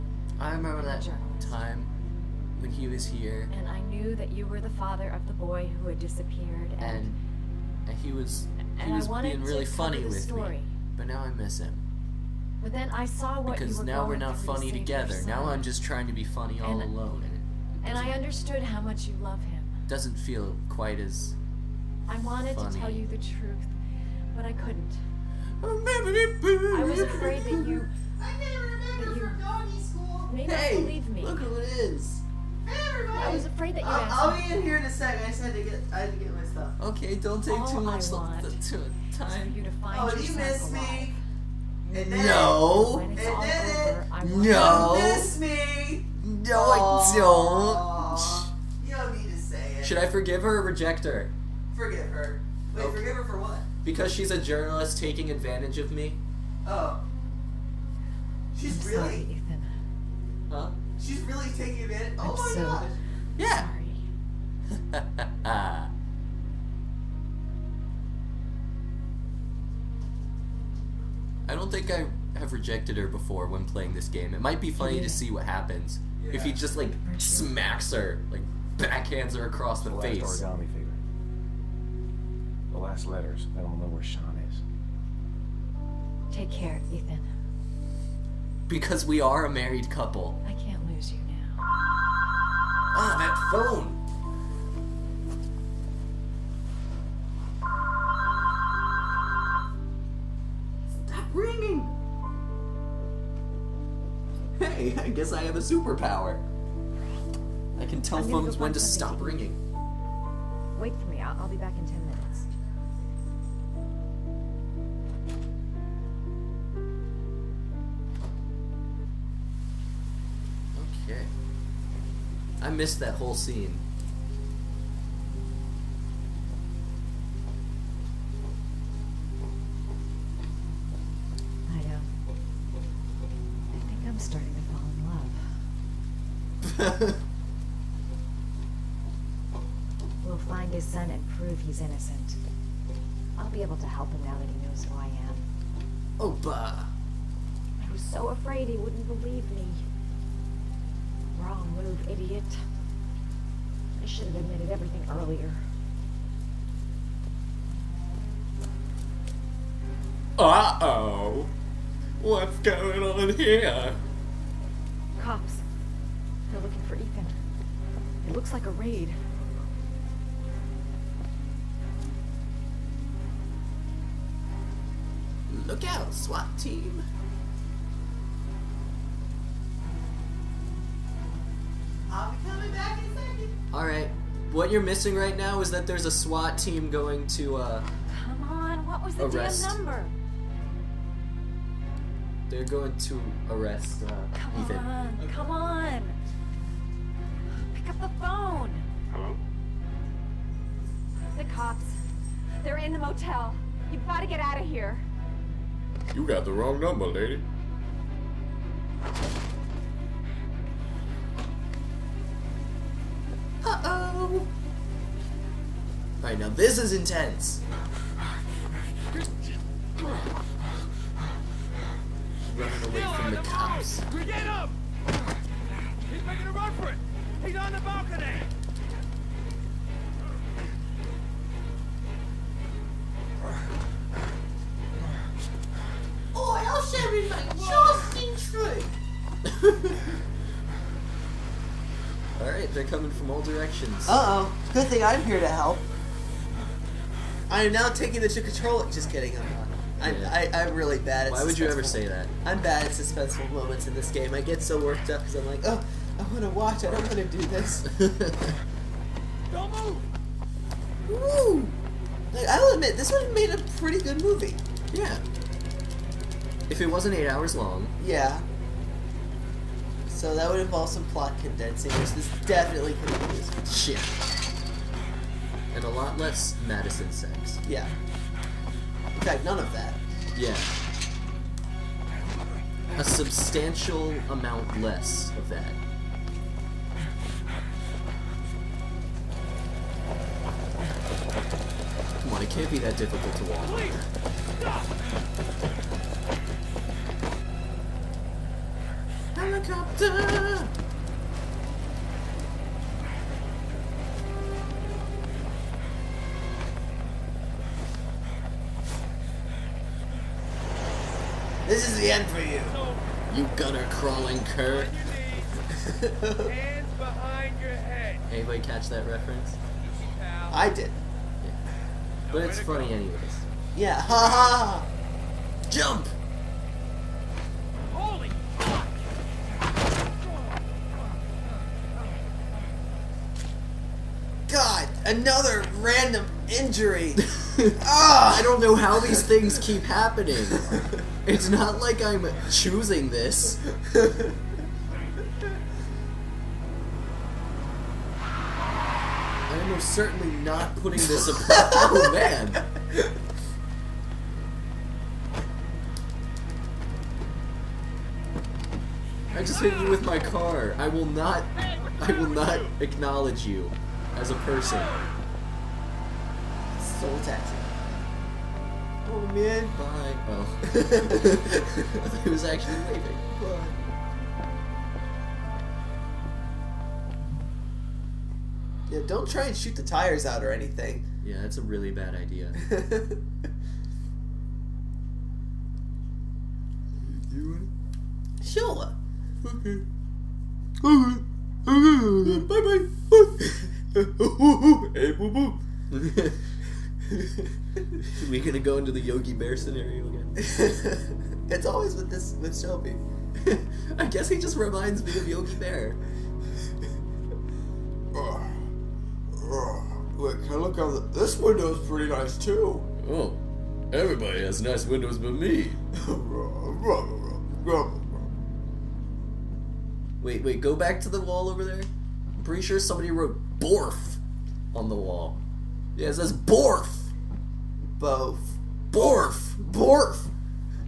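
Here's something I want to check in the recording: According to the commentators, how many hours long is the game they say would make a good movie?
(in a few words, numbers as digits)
8.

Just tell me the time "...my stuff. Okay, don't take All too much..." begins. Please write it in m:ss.
0:36.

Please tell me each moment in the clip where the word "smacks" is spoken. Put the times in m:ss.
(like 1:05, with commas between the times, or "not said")
1:17.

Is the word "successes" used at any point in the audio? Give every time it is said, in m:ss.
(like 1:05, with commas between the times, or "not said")
not said.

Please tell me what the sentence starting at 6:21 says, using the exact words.
Yeah, that's a really bad idea.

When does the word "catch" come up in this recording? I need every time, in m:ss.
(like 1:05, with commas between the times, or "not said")
5:18.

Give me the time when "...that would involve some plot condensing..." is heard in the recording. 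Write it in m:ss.
4:30.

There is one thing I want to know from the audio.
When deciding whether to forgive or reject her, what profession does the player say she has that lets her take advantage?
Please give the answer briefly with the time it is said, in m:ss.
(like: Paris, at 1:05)
journalist, at 0:54.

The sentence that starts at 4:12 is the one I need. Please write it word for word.
I'm bad at suspenseful moments in this game.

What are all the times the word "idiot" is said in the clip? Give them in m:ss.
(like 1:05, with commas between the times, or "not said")
2:32.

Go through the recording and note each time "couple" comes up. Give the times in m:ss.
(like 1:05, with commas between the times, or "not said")
1:29.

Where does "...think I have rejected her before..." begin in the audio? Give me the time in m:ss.
1:11.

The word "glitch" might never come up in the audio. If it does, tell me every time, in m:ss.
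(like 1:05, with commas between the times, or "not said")
not said.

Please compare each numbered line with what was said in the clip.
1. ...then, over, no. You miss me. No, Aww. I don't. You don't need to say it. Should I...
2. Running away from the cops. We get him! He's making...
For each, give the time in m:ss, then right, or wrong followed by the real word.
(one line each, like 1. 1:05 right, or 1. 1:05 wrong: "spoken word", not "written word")
1. 0:43 right
2. 3:42 right.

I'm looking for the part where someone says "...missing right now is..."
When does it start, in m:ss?
3:04.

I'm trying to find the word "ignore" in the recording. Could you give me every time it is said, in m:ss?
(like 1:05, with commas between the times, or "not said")
not said.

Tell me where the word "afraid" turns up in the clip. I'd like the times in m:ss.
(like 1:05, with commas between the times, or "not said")
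0:26, 0:33, 2:28.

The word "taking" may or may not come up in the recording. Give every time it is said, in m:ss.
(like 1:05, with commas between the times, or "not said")
0:54, 1:01, 4:07.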